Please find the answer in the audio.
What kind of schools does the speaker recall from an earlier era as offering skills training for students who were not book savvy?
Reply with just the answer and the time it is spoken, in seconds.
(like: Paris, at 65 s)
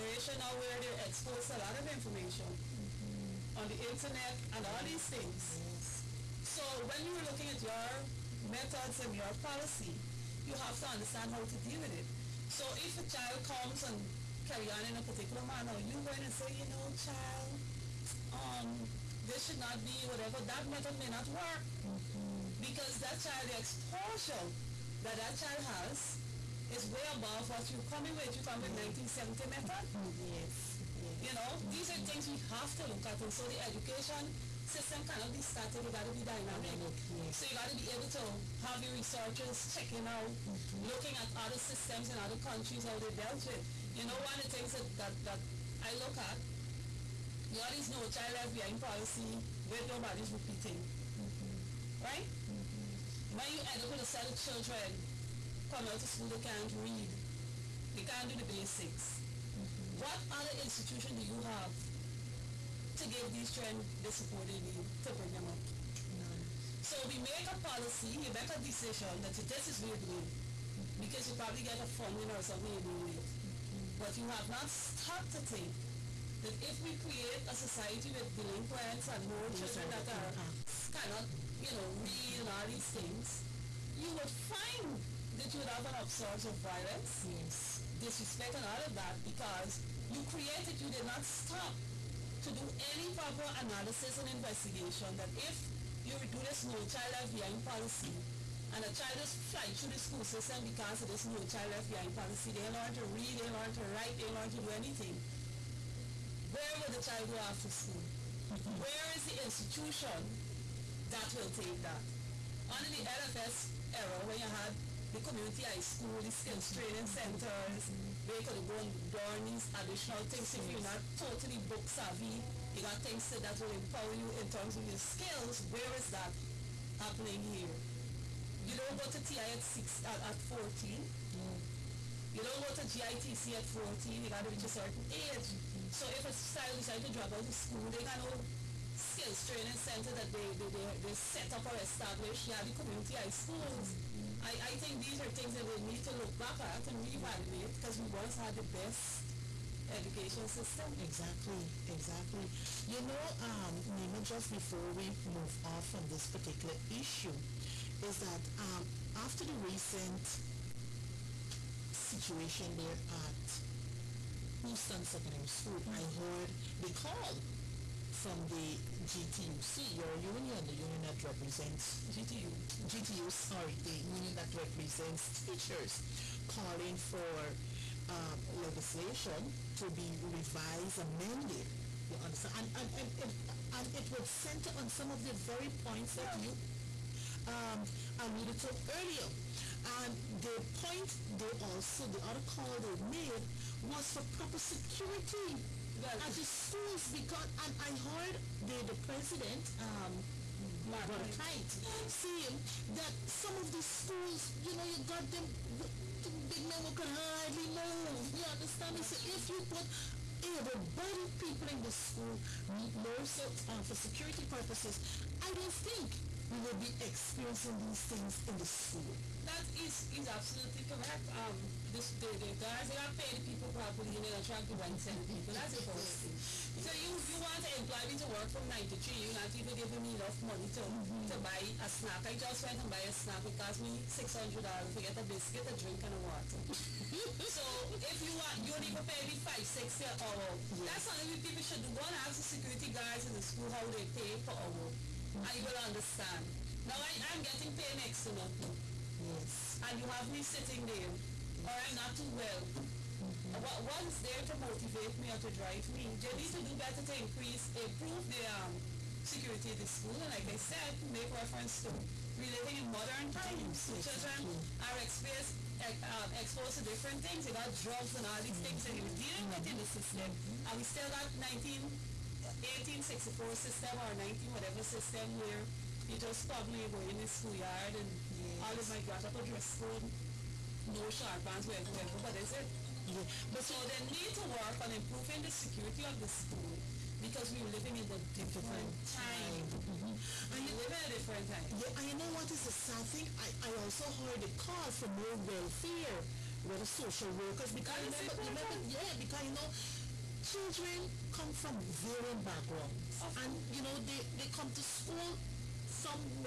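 community high schools, at 115 s.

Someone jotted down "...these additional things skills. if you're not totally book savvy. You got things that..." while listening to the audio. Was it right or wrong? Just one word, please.
right.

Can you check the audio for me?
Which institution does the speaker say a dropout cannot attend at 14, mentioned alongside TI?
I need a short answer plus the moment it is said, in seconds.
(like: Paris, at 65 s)
GITC, at 132 s.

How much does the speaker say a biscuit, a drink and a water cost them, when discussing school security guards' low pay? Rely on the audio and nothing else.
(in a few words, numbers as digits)
$600.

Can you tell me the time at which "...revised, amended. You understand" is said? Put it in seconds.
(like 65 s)
180 s.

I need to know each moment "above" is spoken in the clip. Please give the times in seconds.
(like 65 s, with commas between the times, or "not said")
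27 s.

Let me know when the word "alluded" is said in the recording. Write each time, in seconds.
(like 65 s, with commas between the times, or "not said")
188 s.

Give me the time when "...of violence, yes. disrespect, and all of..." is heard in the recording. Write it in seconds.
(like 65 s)
86 s.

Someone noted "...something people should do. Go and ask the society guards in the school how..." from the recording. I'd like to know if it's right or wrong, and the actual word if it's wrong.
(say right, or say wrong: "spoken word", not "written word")
wrong: "security", not "society".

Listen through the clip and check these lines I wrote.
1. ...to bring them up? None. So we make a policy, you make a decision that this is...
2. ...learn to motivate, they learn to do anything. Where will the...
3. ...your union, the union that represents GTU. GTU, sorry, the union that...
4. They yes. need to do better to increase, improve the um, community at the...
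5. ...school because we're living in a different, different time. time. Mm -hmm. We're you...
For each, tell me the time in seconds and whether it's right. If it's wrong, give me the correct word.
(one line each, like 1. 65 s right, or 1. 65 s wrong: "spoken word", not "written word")
1. 65 s right
2. 103 s wrong: "write", not "motivate"
3. 169 s right
4. 256 s wrong: "security", not "community"
5. 286 s right.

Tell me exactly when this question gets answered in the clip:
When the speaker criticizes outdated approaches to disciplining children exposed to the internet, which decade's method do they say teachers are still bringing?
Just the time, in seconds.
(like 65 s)
28 s.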